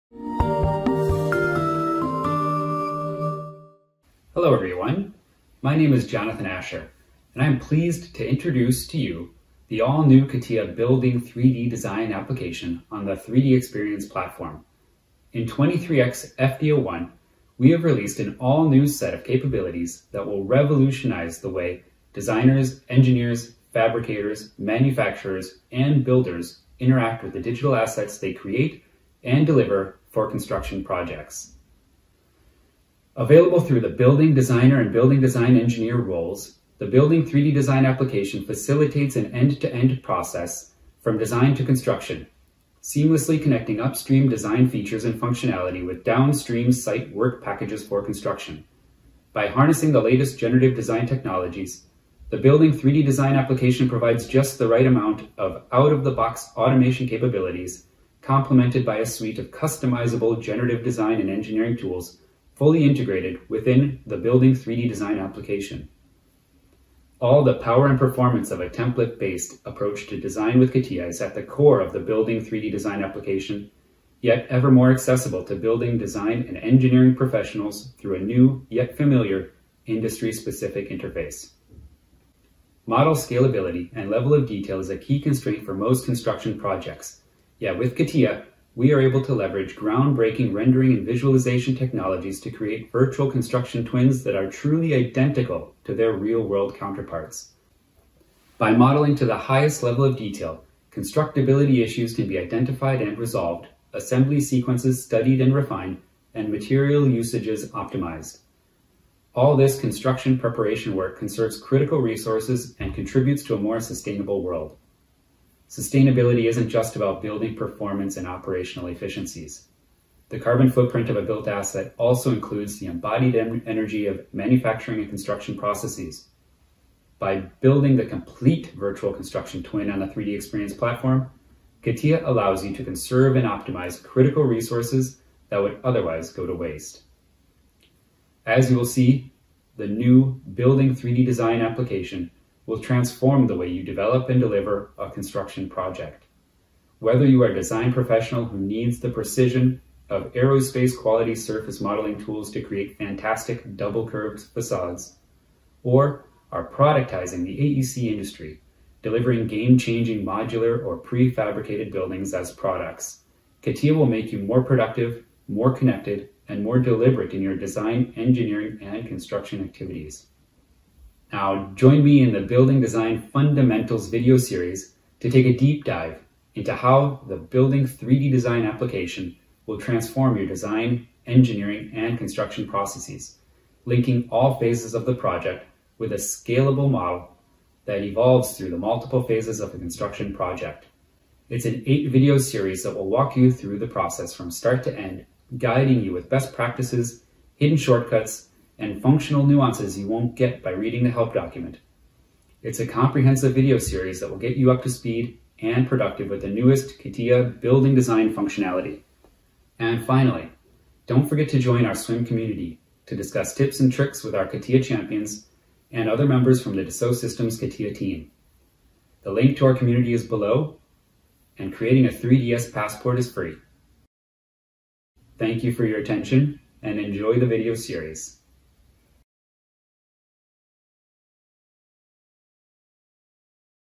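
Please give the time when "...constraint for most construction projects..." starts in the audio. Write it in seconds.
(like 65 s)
85 s.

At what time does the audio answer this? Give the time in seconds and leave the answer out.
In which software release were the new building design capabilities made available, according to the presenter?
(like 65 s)
15 s.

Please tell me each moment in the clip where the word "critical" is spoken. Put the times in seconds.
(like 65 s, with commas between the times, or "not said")
111 s, 134 s.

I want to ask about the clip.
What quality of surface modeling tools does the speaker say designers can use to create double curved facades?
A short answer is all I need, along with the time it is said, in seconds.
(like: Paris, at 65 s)
Aerospace quality, at 150 s.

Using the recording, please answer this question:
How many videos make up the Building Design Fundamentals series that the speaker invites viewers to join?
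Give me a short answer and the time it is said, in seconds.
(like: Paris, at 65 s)
8, at 191 s.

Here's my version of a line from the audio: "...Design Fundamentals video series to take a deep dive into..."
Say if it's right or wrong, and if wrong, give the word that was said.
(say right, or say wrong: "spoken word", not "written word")
right.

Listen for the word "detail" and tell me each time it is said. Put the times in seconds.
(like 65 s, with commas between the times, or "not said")
84 s, 100 s.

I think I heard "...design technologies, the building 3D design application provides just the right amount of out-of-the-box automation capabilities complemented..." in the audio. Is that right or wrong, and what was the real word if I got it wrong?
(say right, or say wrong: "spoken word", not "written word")
right.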